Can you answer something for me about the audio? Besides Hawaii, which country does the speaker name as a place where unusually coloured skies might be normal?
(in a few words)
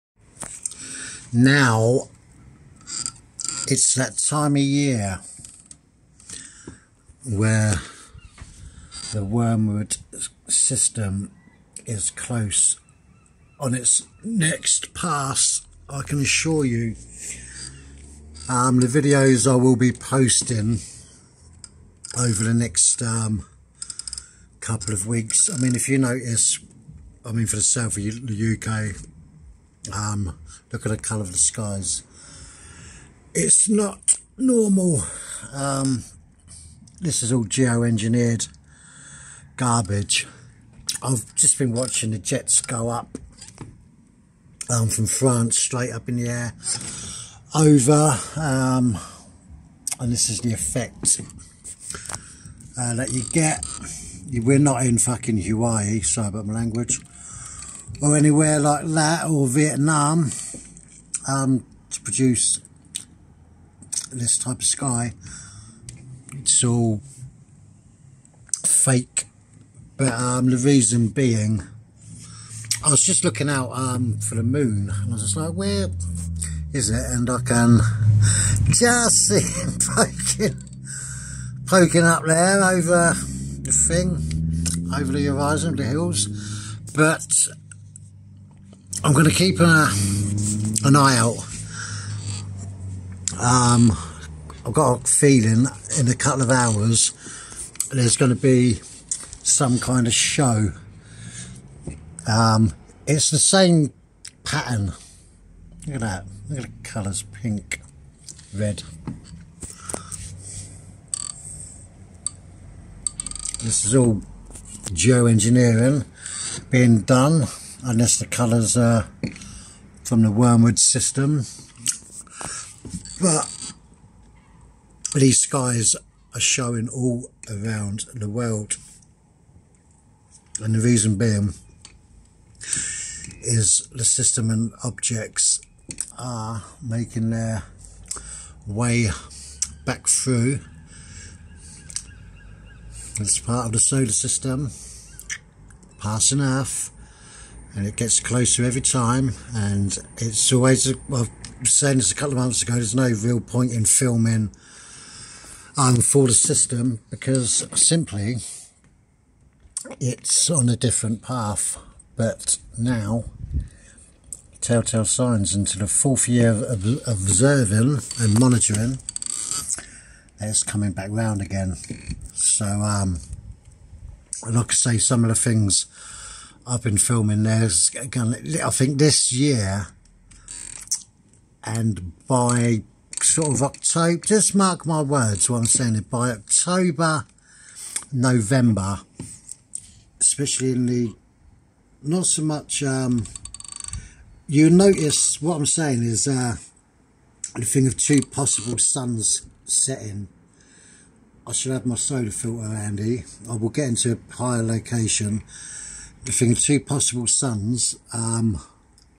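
Vietnam.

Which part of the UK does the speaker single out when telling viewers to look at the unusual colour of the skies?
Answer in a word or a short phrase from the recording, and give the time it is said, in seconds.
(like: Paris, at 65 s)
the south, at 27 s.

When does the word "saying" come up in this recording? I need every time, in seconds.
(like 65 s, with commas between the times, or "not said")
151 s, 185 s, 195 s.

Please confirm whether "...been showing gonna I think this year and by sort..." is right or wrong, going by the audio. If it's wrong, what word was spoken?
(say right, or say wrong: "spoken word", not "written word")
wrong: "filming", not "showing".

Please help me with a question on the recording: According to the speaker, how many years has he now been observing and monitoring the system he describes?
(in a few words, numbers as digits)
4.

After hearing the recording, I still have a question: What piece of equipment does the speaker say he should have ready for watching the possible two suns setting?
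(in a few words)
solar filter.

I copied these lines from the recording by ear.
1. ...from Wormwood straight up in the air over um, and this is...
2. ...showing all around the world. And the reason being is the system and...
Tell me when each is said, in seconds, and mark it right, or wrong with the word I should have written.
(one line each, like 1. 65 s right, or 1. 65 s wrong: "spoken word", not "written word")
1. 44 s wrong: "France", not "Wormwood"
2. 126 s right.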